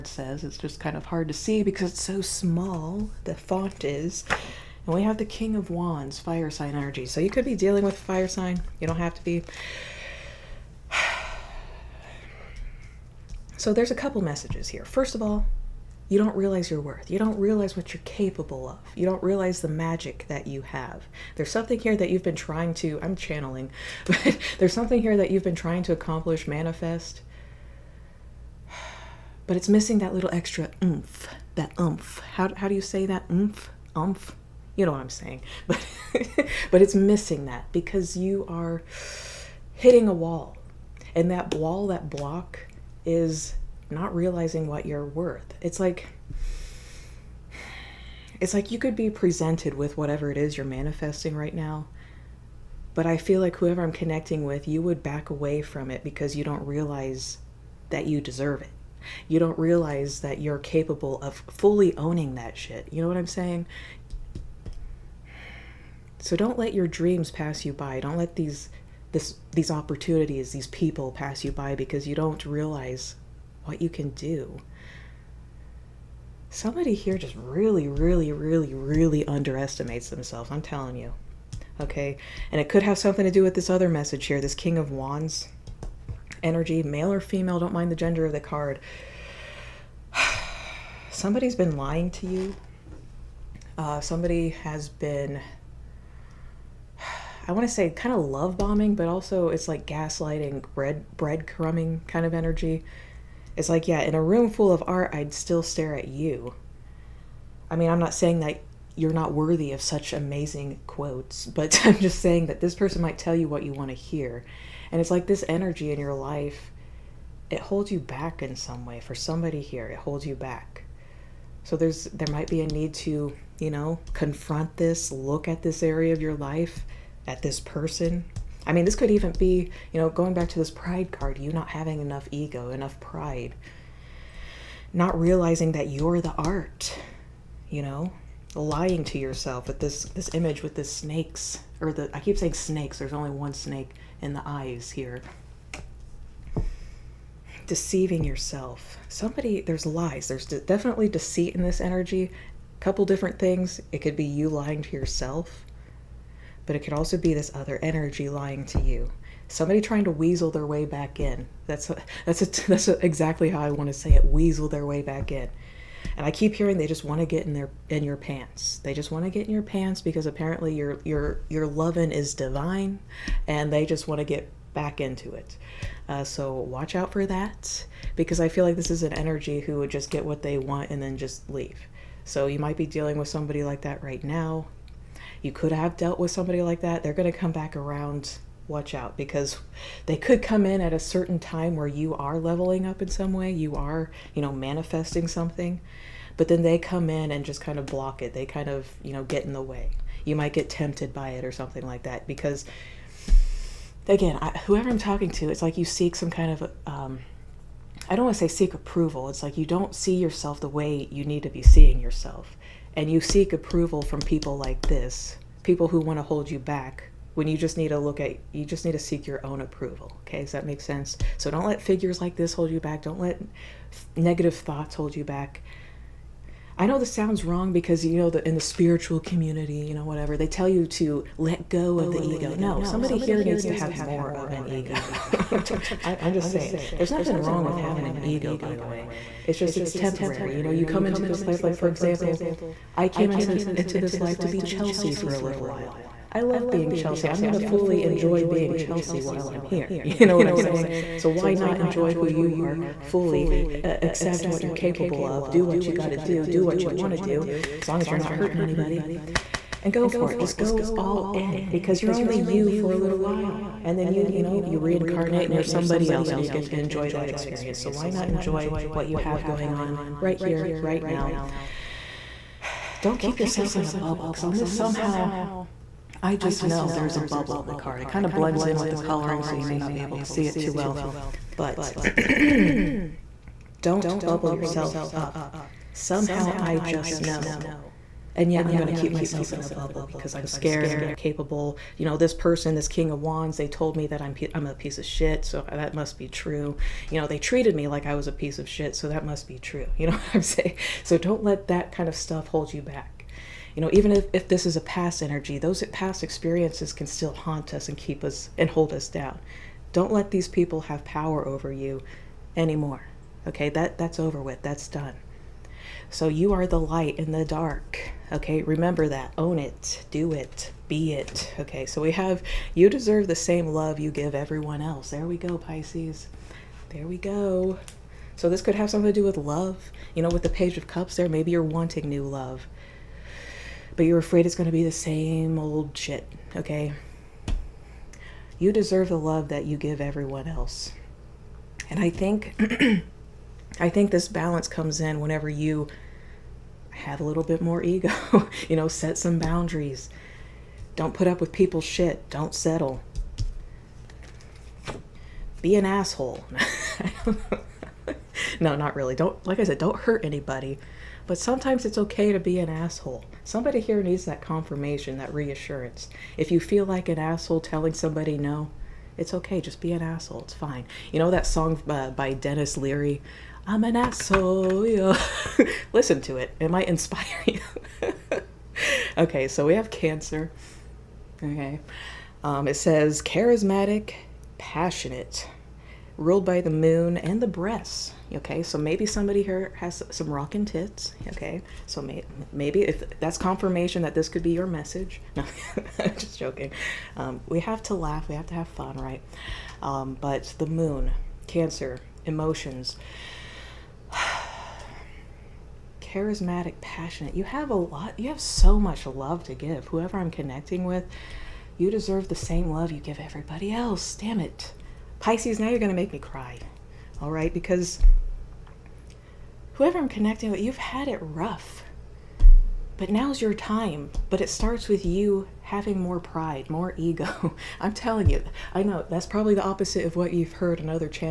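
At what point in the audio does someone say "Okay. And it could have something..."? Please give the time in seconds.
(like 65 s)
81 s.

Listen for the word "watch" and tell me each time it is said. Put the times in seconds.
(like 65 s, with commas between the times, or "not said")
176 s, 188 s.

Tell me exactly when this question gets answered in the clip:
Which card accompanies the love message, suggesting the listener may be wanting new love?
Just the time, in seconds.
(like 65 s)
330 s.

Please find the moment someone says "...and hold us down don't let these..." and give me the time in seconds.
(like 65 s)
308 s.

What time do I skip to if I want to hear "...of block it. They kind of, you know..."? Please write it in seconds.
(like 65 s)
197 s.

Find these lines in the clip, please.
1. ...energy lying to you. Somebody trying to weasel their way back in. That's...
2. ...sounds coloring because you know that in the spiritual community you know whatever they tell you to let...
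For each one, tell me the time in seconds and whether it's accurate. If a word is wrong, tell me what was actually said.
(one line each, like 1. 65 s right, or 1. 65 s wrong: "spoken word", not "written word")
1. 157 s right
2. 227 s wrong: "wrong", not "coloring".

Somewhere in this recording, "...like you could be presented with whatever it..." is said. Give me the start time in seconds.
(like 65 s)
48 s.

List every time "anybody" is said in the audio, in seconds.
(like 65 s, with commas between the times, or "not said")
258 s, 360 s.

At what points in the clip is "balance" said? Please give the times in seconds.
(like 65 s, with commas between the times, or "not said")
344 s.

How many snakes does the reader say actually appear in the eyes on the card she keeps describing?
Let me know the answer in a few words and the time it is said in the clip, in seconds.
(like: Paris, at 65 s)
1, at 143 s.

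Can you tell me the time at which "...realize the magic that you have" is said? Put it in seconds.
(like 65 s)
19 s.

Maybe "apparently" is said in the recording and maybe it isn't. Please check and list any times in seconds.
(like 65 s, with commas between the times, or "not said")
170 s.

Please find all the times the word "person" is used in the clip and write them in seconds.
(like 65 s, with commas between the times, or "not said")
112 s, 127 s, 292 s.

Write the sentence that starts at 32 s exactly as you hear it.
How, how do you say that oomph, oomph?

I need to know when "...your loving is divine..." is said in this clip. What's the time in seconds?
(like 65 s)
171 s.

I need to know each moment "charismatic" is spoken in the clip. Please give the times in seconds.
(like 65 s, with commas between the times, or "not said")
383 s, 406 s.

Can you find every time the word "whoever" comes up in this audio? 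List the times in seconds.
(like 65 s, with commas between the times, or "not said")
53 s, 204 s, 409 s, 419 s.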